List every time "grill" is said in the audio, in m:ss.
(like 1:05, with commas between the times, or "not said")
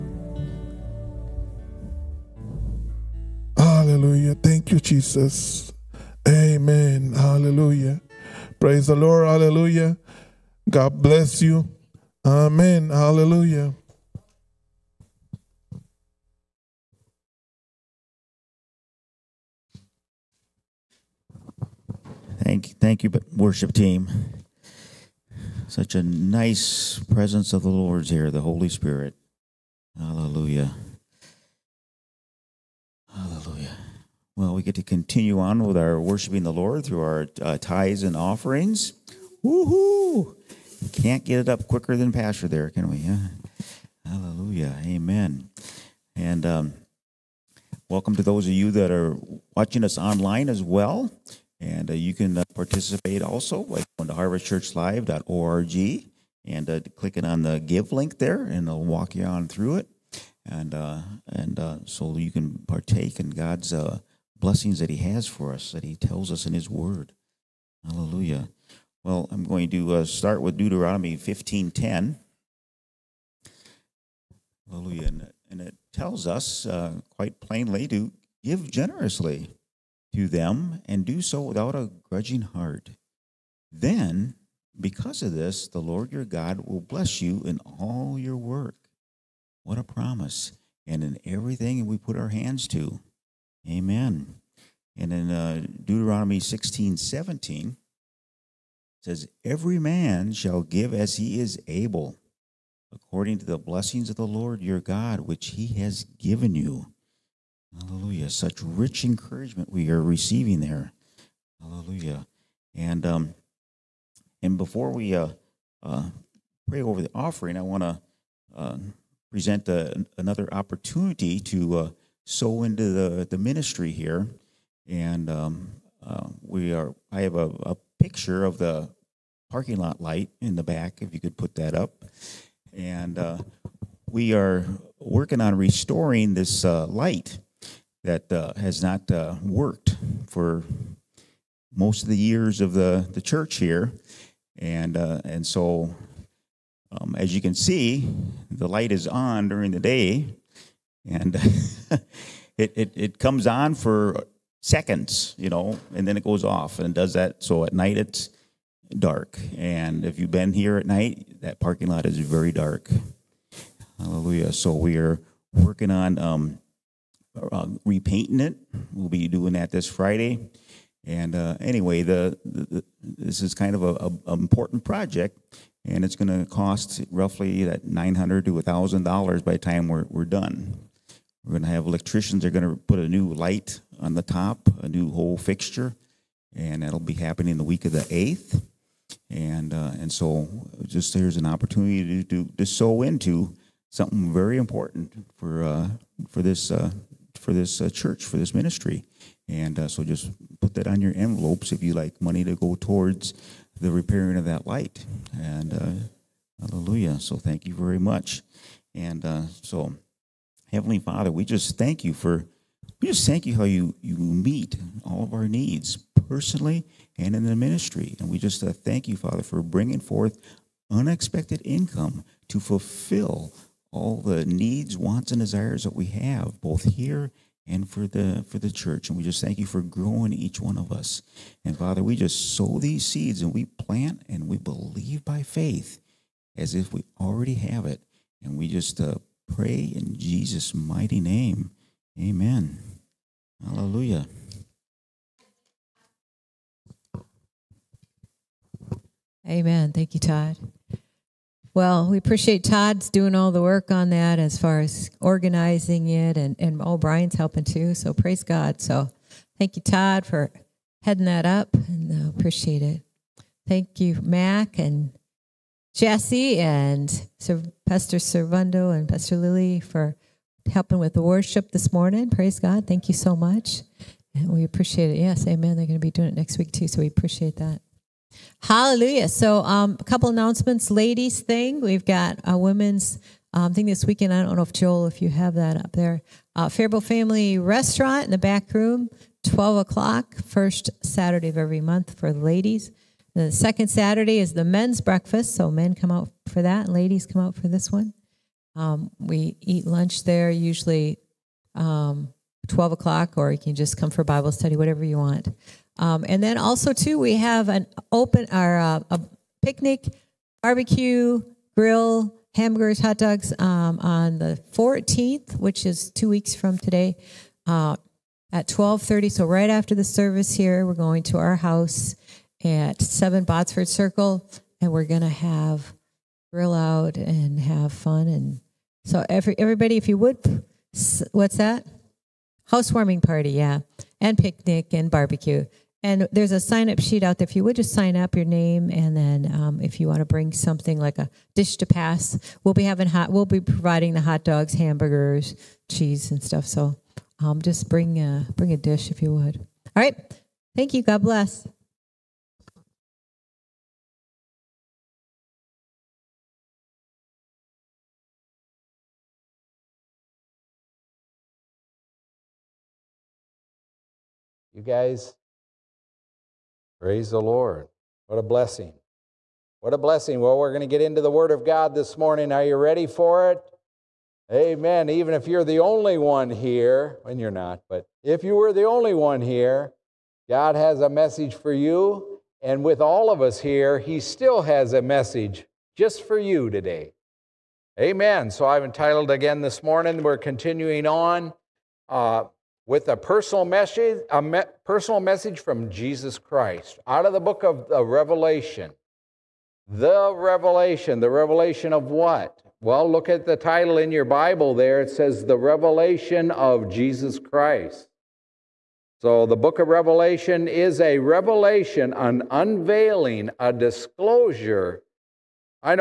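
5:11, 5:26.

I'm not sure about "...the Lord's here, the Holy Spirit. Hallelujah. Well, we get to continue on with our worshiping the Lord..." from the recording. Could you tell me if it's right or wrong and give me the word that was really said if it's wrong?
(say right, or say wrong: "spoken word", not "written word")
right.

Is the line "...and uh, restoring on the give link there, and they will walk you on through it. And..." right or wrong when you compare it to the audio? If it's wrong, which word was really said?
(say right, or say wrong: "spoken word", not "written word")
wrong: "clicking", not "restoring".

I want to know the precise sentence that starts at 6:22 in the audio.
And with all of us here, He still has a message just for you today.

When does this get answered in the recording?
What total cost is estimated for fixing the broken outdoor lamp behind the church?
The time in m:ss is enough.
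2:57.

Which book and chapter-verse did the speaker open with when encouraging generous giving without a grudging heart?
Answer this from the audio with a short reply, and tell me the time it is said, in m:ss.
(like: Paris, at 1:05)
Deuteronomy 15:10, at 1:10.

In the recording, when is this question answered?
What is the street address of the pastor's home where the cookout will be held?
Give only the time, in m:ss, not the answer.
5:23.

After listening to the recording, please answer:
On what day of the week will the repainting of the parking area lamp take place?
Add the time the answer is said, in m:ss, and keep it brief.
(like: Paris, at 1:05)
Friday, at 2:49.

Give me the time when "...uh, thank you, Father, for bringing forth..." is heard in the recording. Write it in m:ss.
3:38.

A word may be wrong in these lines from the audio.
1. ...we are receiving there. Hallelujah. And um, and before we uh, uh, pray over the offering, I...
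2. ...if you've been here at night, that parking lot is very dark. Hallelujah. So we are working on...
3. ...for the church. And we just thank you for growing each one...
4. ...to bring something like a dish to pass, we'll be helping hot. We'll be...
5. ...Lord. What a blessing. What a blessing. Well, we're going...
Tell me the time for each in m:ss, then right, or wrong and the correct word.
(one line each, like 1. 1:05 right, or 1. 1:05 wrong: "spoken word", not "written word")
1. 1:49 right
2. 2:40 right
3. 3:48 right
4. 5:40 wrong: "having", not "helping"
5. 6:07 right.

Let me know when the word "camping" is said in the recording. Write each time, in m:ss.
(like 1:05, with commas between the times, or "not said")
not said.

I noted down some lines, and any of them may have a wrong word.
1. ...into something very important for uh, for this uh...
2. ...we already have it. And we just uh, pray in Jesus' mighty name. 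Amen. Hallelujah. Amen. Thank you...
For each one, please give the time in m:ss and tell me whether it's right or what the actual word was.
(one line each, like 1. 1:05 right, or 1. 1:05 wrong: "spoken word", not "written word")
1. 3:13 right
2. 3:56 right.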